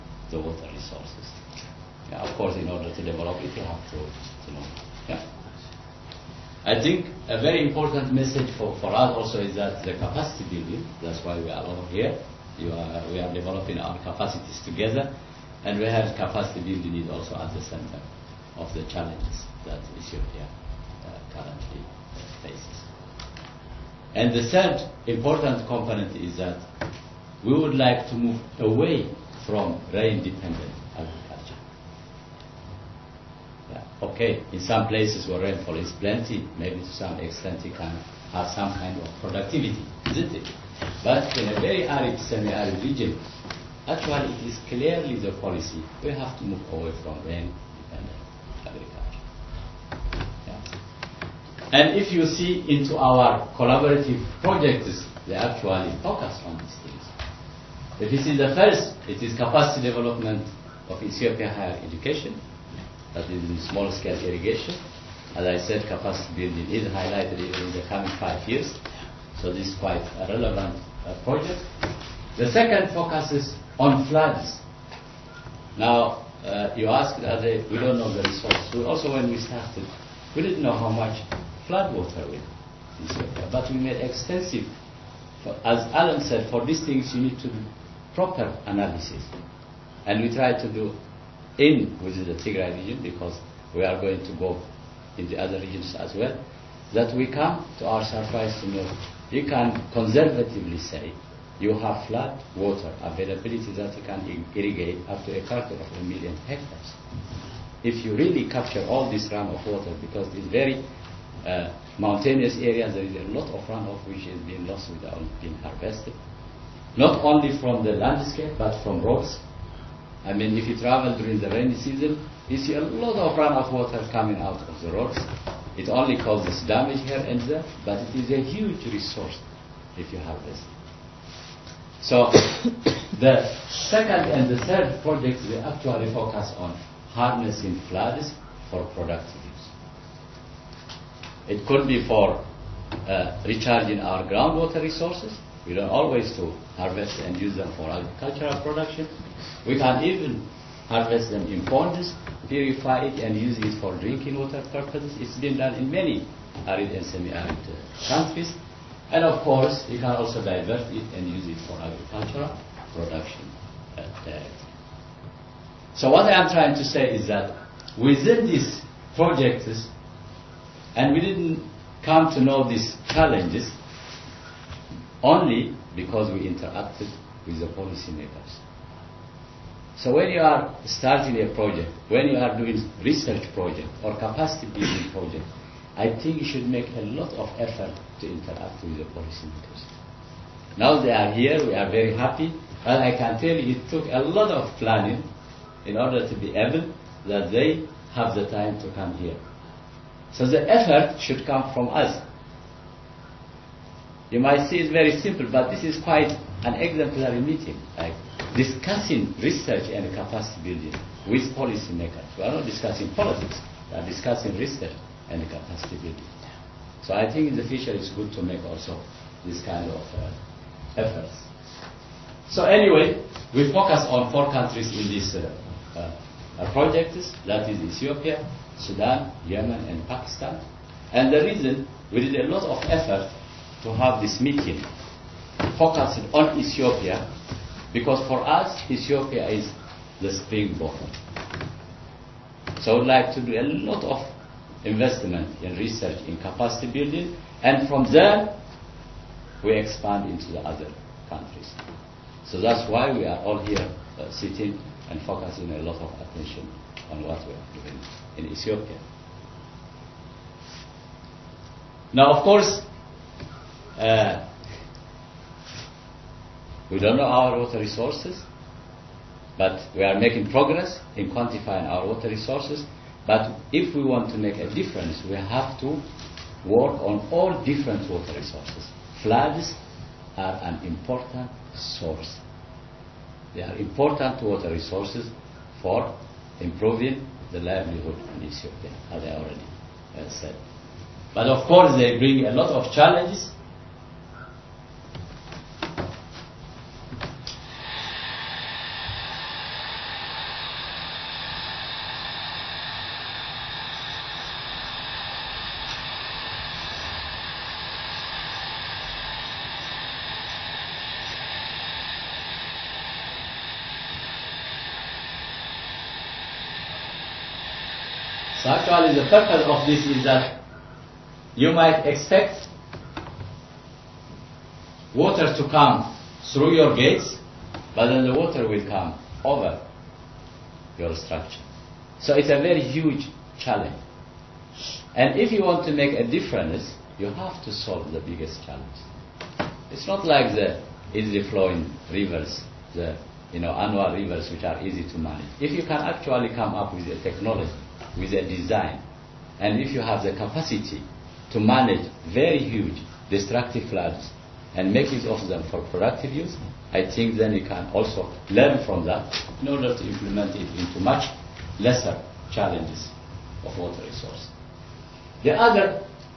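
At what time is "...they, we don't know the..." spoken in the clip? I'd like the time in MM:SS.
01:17.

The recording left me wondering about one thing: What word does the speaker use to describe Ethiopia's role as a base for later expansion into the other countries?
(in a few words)
springboard.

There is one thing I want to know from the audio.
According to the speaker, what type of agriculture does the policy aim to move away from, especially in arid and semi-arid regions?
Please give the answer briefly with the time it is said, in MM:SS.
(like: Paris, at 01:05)
rain-dependent agriculture, at 00:47.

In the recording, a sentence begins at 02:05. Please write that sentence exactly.
It only causes damage here and there, but it is a huge resource if you have this.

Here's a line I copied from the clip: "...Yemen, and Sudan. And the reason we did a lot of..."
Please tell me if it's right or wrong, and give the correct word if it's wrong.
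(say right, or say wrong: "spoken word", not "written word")
wrong: "Pakistan", not "Sudan".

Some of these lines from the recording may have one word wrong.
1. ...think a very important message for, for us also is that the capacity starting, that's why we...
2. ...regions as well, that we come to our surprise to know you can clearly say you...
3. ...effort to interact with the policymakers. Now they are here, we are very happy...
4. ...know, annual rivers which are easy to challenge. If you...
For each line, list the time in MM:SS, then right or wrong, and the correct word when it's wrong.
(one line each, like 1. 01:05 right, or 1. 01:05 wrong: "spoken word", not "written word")
1. 00:06 wrong: "building", not "starting"
2. 01:35 wrong: "conservatively", not "clearly"
3. 03:07 right
4. 05:43 wrong: "manage", not "challenge".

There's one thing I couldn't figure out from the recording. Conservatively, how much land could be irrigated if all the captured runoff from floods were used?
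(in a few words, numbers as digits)
a quarter of a million hectares.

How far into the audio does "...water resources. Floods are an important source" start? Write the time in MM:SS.
04:38.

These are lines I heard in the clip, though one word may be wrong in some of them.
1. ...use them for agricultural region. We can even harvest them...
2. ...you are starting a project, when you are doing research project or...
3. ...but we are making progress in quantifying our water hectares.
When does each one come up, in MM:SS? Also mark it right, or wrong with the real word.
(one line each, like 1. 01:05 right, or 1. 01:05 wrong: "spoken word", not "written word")
1. 02:27 wrong: "production", not "region"
2. 03:00 right
3. 04:29 wrong: "resources", not "hectares".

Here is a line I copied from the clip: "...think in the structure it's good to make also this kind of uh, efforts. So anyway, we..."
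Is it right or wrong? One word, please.
wrong.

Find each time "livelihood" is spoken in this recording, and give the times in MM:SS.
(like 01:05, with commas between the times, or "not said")
04:47.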